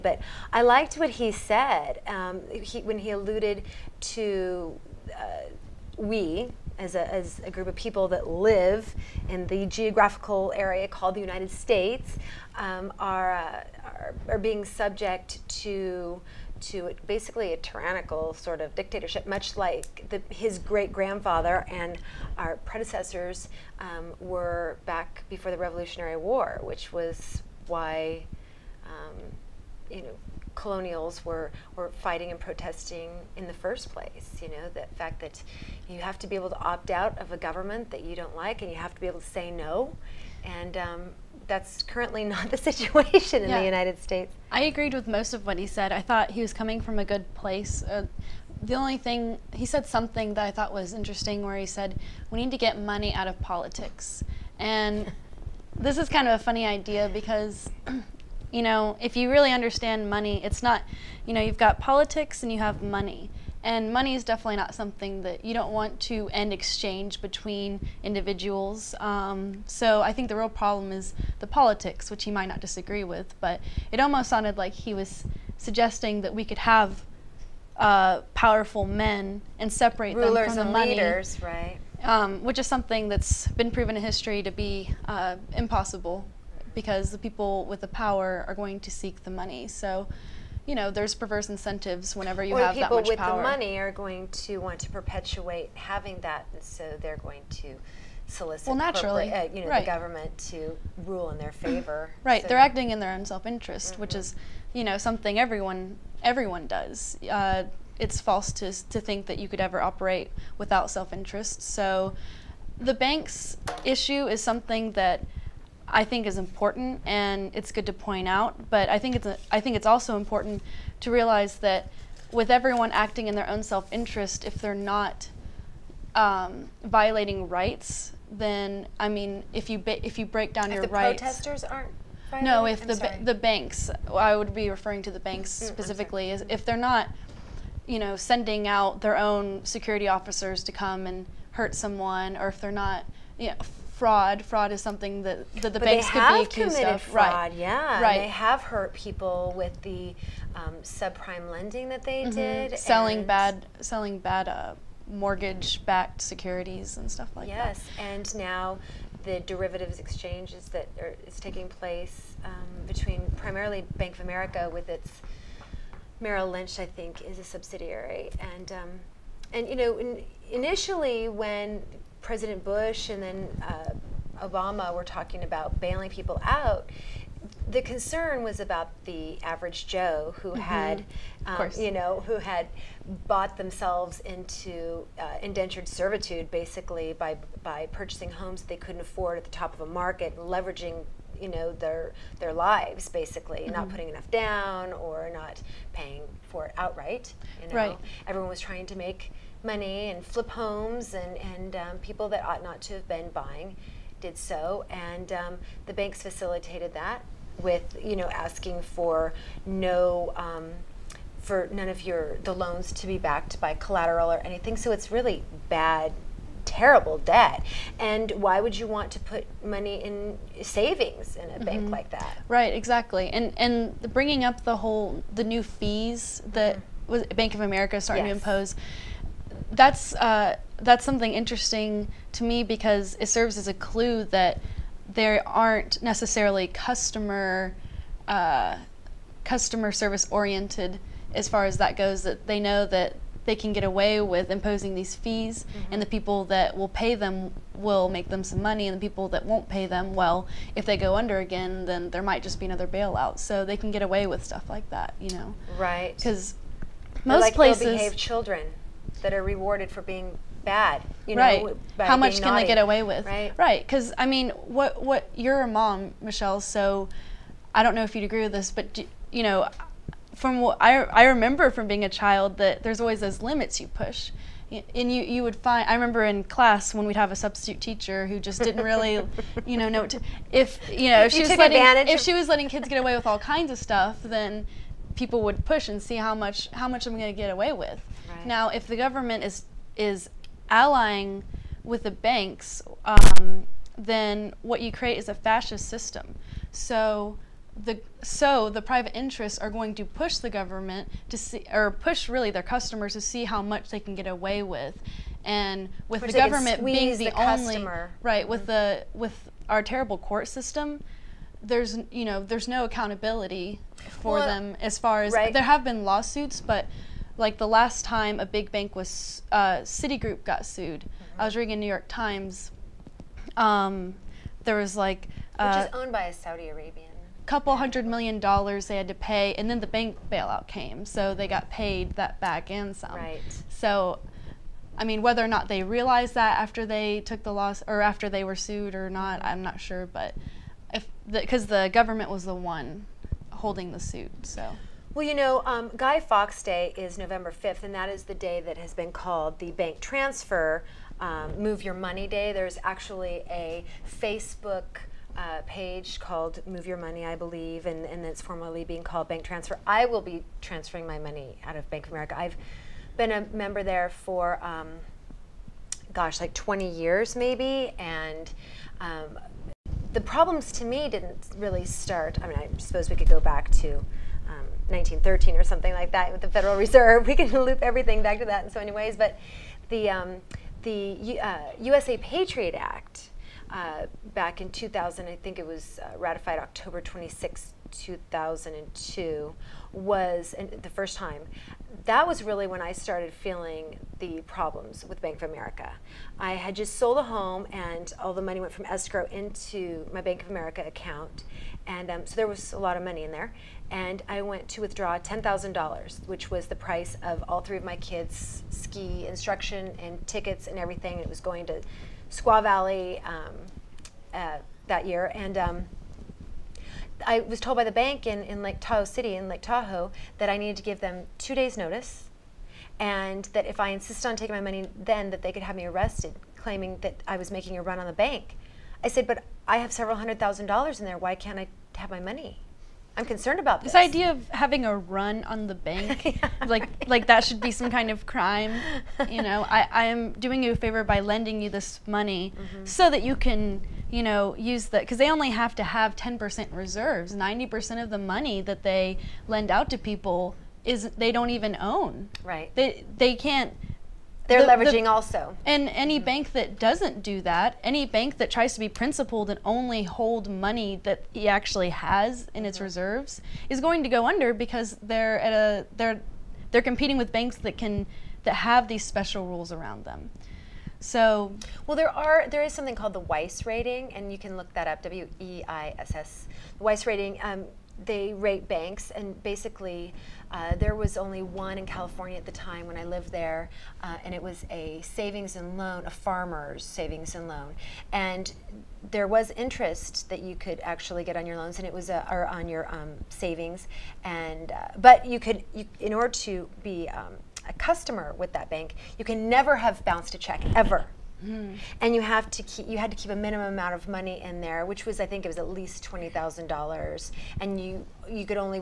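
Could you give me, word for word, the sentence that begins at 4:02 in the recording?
That they know that they can get away with imposing these fees, mm-hmm.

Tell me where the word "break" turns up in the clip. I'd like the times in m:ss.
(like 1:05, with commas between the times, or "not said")
2:10.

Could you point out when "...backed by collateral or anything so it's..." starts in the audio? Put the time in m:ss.
3:33.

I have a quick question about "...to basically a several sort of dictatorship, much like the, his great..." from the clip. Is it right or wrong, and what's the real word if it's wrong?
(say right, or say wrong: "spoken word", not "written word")
wrong: "tyrannical", not "several".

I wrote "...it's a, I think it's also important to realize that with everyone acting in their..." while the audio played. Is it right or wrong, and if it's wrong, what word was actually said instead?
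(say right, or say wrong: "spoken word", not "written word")
right.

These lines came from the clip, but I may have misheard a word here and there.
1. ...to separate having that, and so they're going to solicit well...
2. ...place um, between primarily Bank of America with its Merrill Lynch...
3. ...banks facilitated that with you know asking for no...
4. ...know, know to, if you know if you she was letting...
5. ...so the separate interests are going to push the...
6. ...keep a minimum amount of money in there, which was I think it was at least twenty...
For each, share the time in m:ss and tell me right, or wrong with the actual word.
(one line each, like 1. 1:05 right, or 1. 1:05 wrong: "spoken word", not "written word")
1. 1:34 wrong: "perpetuate", not "separate"
2. 2:41 right
3. 3:25 right
4. 4:39 right
5. 4:58 wrong: "private", not "separate"
6. 8:23 right.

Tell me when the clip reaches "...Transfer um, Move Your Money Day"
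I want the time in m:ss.
5:49.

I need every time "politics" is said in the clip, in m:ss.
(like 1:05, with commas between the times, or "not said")
0:53, 1:01, 1:11.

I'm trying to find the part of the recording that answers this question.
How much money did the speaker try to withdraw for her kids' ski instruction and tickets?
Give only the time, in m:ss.
6:45.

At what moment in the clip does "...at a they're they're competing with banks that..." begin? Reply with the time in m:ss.
7:45.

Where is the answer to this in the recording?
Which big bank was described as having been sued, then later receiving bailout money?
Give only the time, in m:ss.
5:19.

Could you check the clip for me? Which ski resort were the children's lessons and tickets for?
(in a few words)
Squaw Valley.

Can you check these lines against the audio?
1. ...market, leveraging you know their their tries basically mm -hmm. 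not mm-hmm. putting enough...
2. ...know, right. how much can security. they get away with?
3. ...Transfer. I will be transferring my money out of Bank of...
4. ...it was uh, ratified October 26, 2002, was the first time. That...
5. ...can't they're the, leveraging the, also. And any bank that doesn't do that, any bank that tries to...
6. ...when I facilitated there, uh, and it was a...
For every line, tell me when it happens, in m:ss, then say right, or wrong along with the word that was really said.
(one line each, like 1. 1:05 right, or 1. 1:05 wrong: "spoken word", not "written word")
1. 3:10 wrong: "lives", not "tries"
2. 4:21 wrong: "naughty", not "security"
3. 5:59 right
4. 6:25 right
5. 7:33 right
6. 8:02 wrong: "lived", not "facilitated".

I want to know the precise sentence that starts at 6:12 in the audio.
I mean, I suppose we could go back to 1913 or something like that with the Federal Reserve.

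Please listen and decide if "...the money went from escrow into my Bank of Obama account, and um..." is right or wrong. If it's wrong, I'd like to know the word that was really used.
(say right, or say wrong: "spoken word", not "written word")
wrong: "America", not "Obama".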